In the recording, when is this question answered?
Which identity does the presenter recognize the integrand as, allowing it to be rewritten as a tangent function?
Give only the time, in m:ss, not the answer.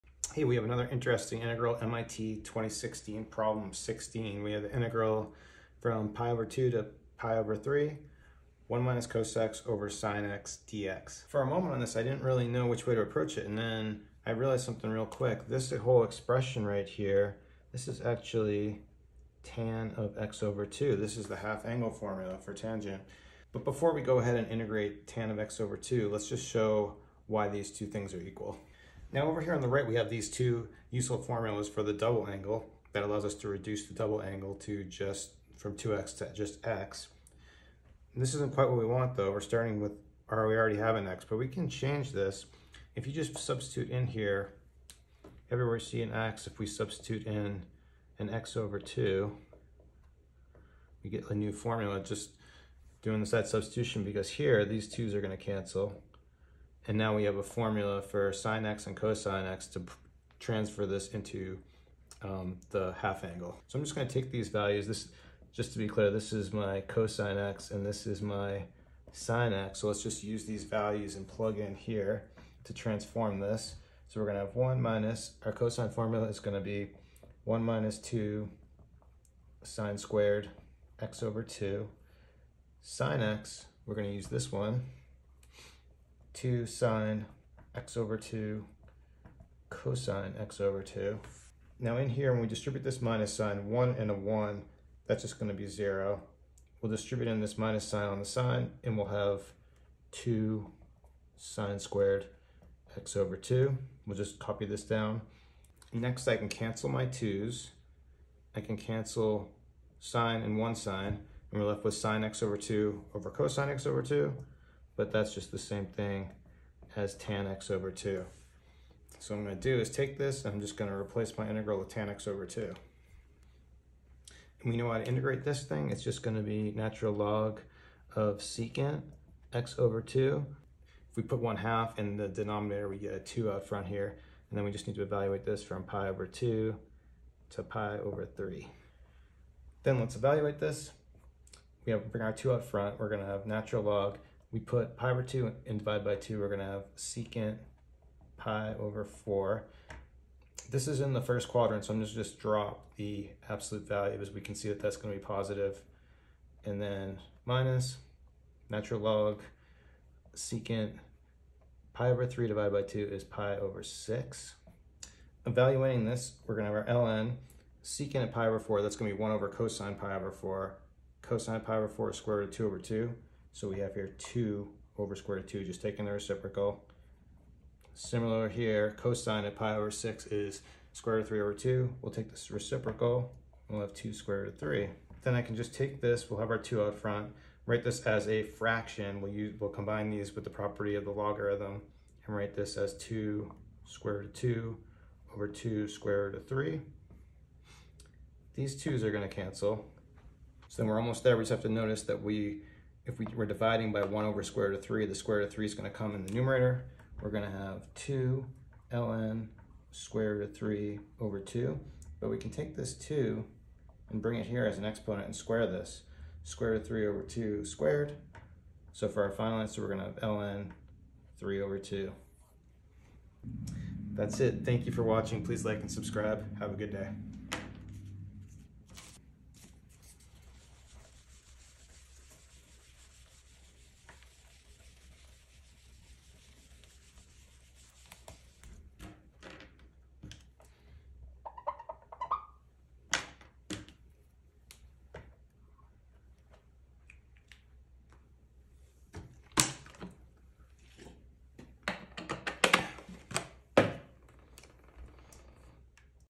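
0:21.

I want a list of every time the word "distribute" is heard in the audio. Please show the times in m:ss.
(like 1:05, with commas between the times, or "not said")
1:32, 1:36.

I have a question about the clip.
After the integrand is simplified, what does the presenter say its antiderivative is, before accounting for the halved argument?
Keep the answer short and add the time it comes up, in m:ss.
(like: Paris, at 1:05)
natural log of secant, at 2:06.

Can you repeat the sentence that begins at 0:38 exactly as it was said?
And this isn't quite what we want though.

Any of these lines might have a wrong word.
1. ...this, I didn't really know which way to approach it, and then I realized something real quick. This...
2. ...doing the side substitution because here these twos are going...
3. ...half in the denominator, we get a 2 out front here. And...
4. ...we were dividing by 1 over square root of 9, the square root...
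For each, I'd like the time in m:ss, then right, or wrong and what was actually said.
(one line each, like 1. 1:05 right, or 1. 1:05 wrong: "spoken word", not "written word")
1. 0:11 right
2. 0:53 right
3. 2:11 right
4. 3:23 wrong: "3", not "9".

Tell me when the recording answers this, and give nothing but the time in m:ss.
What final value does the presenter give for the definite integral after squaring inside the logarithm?
3:40.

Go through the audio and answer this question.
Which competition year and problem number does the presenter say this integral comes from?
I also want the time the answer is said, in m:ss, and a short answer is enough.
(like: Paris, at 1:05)
2016 problem 16, at 0:02.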